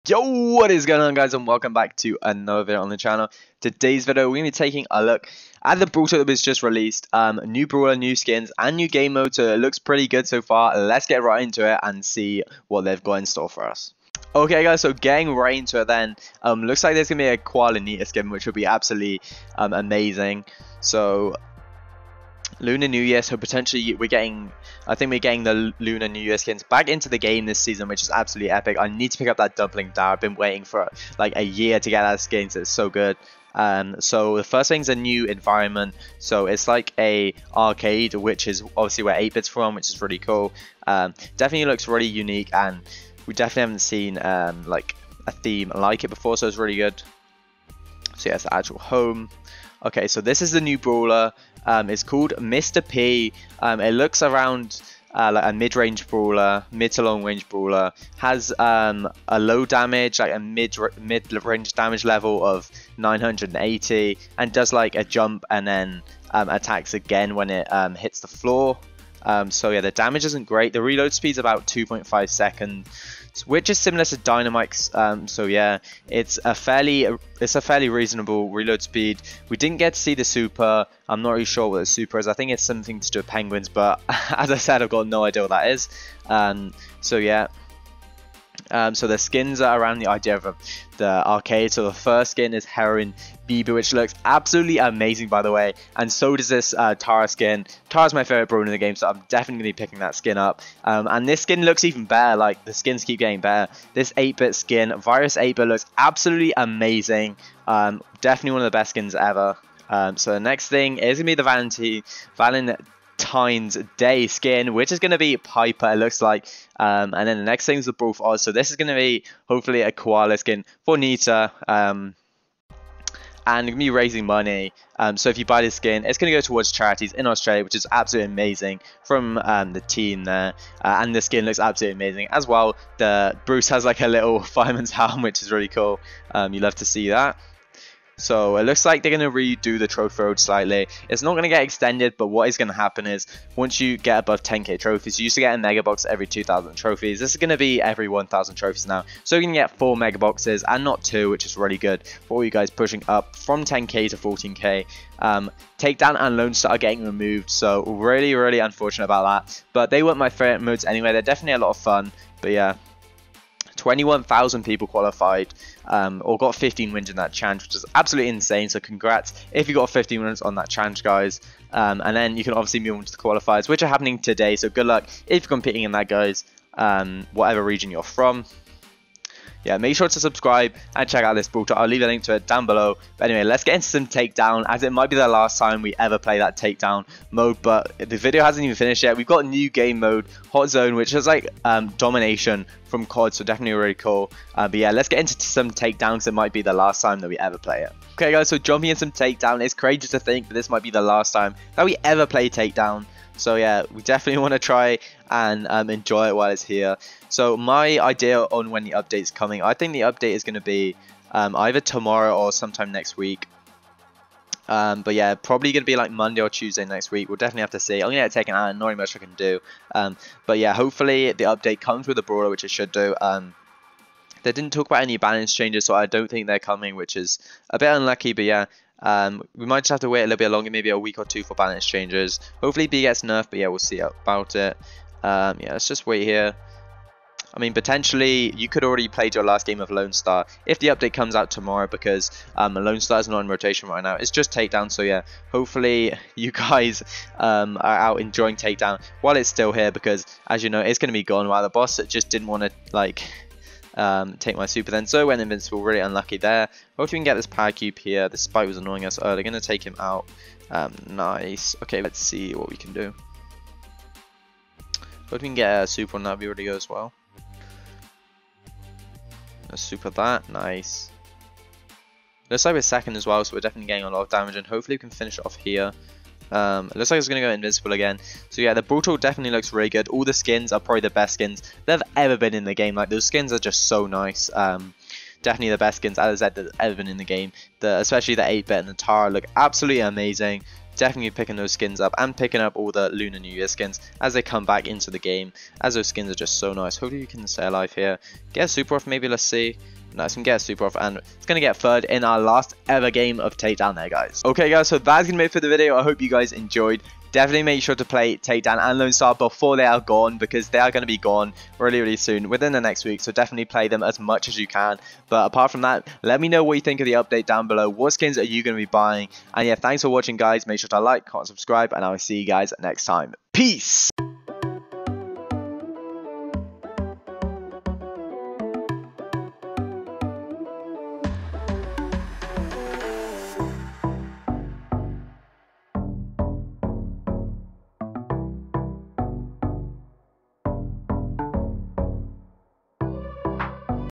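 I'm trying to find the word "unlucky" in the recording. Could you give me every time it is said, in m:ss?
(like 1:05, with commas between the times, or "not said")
3:47, 4:15.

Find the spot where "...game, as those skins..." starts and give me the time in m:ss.
4:55.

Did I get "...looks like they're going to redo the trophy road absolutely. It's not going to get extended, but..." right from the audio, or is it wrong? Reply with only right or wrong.
wrong.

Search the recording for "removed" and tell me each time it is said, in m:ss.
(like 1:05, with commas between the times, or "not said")
2:37.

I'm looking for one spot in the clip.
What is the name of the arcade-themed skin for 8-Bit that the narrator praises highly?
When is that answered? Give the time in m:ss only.
1:44.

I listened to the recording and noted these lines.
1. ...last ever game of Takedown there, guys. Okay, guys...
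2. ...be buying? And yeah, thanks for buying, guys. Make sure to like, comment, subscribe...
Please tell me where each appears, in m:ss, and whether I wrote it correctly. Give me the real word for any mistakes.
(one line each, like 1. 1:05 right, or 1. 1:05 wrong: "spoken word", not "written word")
1. 5:02 right
2. 5:18 wrong: "watching", not "buying".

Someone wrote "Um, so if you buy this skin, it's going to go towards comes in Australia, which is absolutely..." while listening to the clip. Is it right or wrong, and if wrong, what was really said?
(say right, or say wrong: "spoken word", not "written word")
wrong: "charities", not "comes".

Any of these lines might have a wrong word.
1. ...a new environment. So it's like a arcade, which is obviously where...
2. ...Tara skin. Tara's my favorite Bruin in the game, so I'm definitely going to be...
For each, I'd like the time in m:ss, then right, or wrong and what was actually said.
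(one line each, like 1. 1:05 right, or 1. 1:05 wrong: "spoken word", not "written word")
1. 0:34 right
2. 1:36 right.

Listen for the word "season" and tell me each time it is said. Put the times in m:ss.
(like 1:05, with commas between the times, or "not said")
0:27.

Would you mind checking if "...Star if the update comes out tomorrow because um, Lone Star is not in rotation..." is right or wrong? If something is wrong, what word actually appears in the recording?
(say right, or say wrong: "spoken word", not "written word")
right.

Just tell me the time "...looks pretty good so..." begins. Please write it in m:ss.
0:09.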